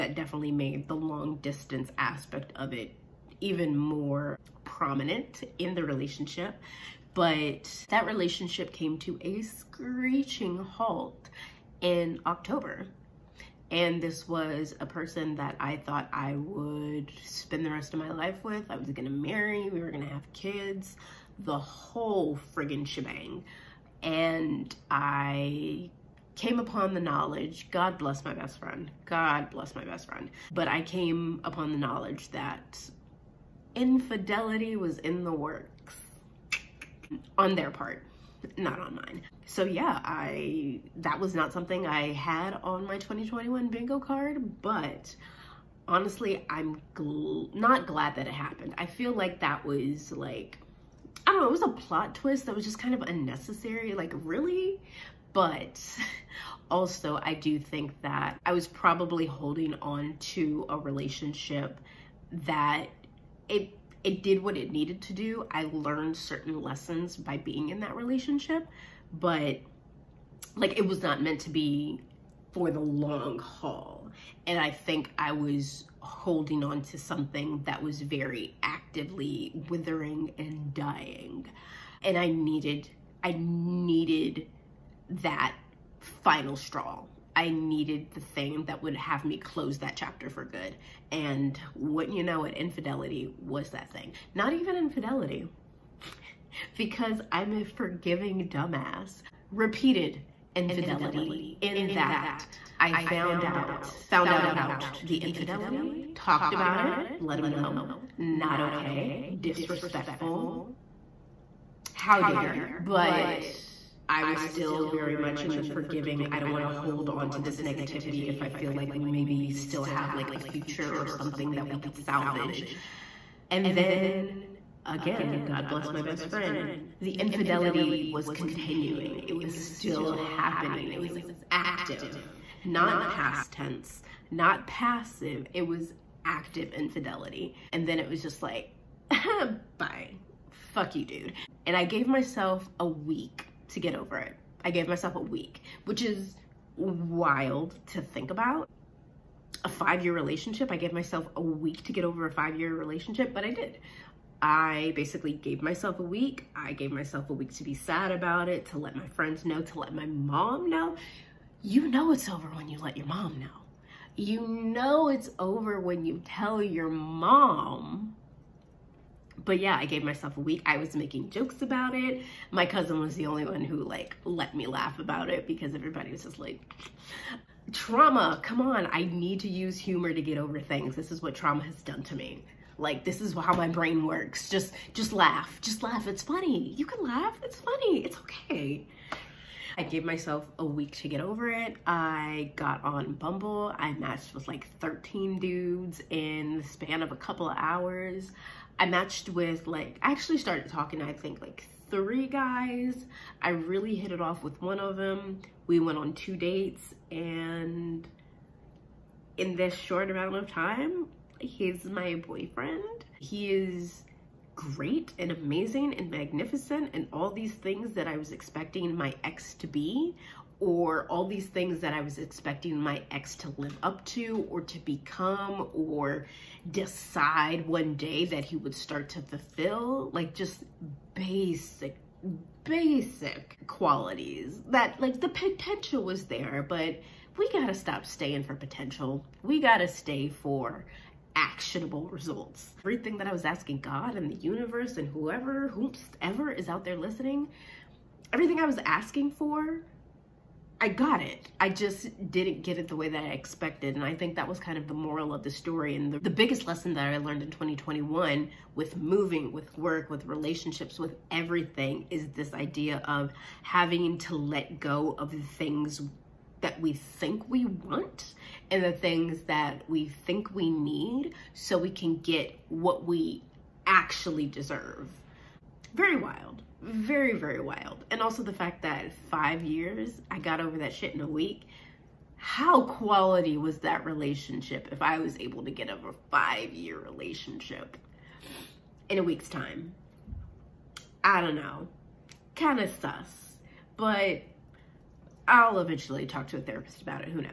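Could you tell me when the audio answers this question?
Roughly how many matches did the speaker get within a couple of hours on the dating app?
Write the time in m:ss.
3:14.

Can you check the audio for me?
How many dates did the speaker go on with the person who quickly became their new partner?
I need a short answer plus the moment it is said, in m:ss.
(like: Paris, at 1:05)
2, at 3:26.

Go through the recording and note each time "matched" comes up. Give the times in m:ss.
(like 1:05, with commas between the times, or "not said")
3:13, 3:18.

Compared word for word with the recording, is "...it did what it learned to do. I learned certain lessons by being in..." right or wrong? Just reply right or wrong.
wrong.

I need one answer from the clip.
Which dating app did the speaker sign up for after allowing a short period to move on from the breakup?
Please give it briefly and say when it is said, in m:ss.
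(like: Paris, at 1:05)
Bumble, at 3:13.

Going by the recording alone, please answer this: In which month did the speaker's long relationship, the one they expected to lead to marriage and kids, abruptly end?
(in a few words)
October.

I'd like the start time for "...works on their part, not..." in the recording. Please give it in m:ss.
0:35.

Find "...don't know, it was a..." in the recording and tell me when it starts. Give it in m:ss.
0:51.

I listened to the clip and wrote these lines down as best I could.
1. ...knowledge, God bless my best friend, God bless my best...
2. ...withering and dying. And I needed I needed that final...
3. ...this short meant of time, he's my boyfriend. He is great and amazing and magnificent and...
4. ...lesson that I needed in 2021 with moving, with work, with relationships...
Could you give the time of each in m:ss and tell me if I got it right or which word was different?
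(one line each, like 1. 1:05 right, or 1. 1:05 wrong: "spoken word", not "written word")
1. 0:27 right
2. 1:19 right
3. 3:29 wrong: "amount", not "meant"
4. 4:16 wrong: "learned", not "needed".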